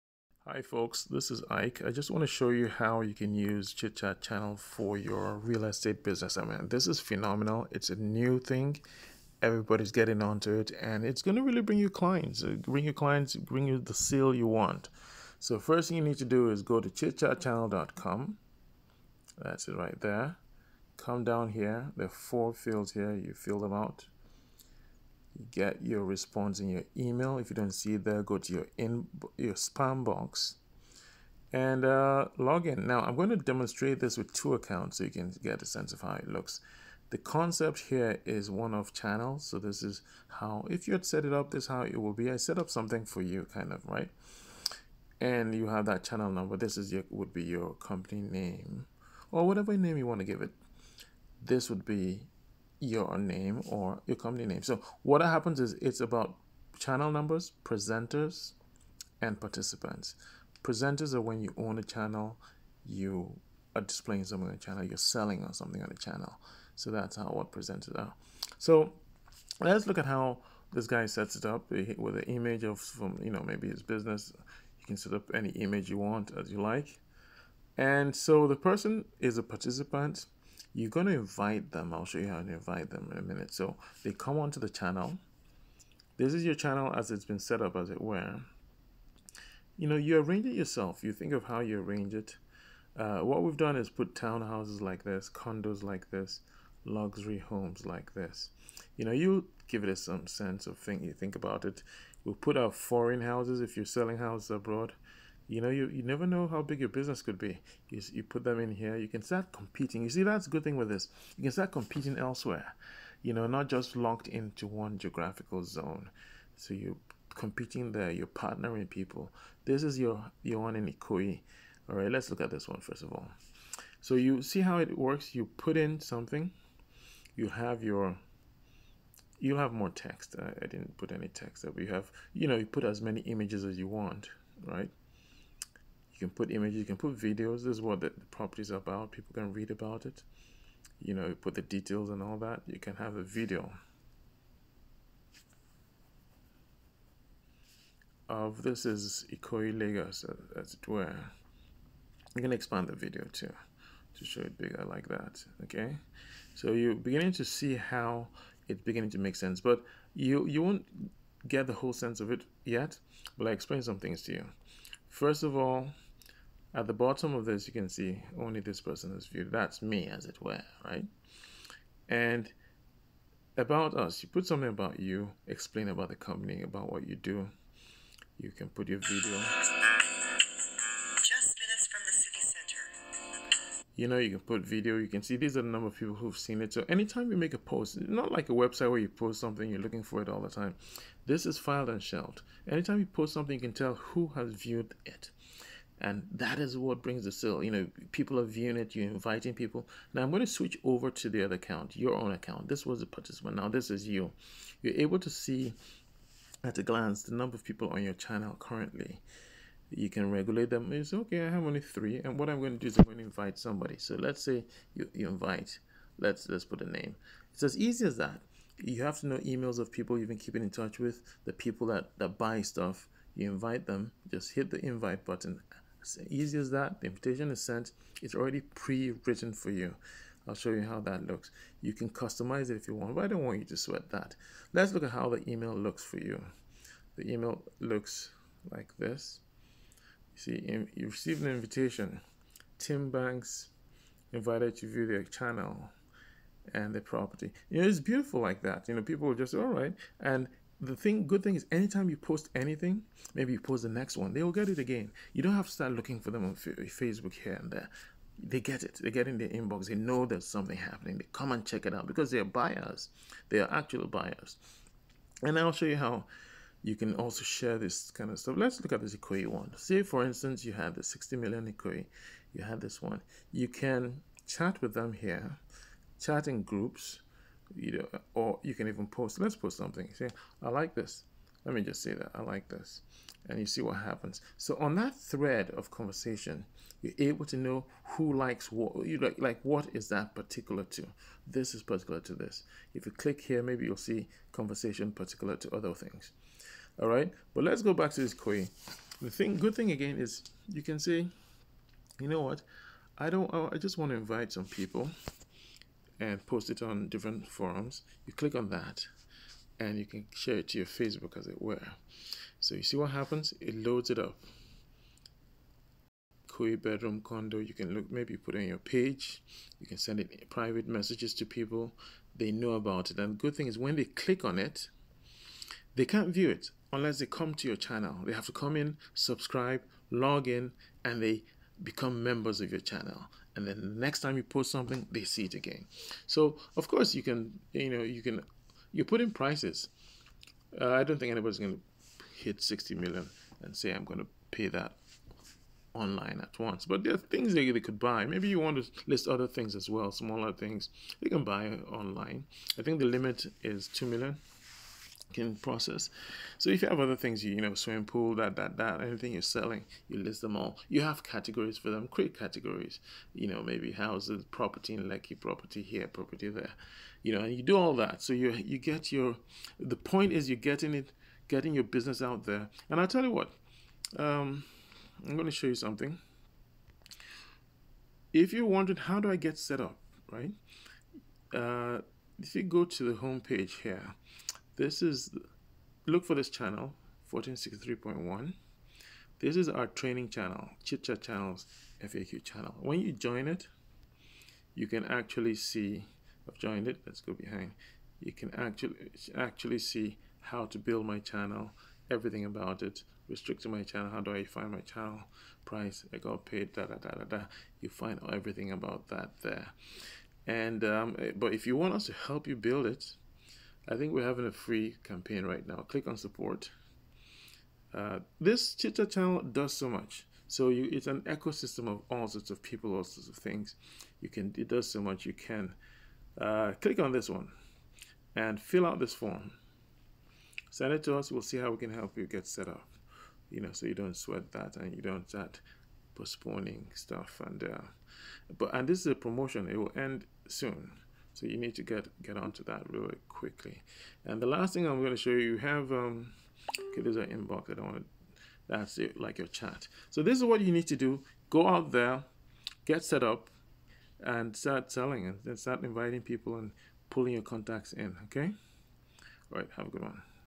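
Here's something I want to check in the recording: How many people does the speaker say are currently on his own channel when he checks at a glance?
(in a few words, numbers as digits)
3.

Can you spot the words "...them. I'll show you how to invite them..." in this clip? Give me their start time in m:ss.
1:21.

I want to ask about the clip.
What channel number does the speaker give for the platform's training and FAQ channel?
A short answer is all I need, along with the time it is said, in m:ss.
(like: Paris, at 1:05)
1463.1, at 6:27.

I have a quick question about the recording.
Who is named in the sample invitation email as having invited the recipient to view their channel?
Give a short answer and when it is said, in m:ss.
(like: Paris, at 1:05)
Tim Banks, at 4:02.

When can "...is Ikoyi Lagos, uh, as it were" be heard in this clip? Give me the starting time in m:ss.
2:28.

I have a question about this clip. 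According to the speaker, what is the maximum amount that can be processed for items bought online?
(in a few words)
2 million.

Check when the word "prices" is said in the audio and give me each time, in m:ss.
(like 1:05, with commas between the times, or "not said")
5:39, 6:45.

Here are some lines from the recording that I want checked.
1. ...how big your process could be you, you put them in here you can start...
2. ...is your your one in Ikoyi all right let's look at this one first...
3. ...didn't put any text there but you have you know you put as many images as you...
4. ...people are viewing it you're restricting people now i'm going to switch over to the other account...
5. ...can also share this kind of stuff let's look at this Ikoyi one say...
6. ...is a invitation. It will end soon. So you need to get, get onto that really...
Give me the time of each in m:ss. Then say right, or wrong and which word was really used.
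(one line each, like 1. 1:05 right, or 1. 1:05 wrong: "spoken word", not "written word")
1. 1:46 wrong: "business", not "process"
2. 1:59 right
3. 2:10 right
4. 3:18 wrong: "inviting", not "restricting"
5. 4:26 right
6. 7:19 wrong: "promotion", not "invitation".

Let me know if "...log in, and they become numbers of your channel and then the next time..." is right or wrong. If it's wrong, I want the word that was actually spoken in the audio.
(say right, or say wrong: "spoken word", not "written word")
wrong: "members", not "numbers".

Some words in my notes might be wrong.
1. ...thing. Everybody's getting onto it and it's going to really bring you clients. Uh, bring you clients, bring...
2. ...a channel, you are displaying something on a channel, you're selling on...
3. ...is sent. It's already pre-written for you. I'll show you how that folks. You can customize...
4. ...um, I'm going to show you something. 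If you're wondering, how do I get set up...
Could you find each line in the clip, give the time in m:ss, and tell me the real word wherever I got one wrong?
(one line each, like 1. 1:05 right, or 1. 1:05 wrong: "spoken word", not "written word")
1. 0:08 right
2. 1:01 right
3. 3:47 wrong: "looks", not "folks"
4. 6:14 right.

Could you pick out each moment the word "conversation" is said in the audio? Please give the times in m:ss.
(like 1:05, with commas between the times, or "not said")
4:45, 4:54.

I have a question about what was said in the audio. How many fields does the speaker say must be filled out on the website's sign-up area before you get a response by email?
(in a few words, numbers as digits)
4.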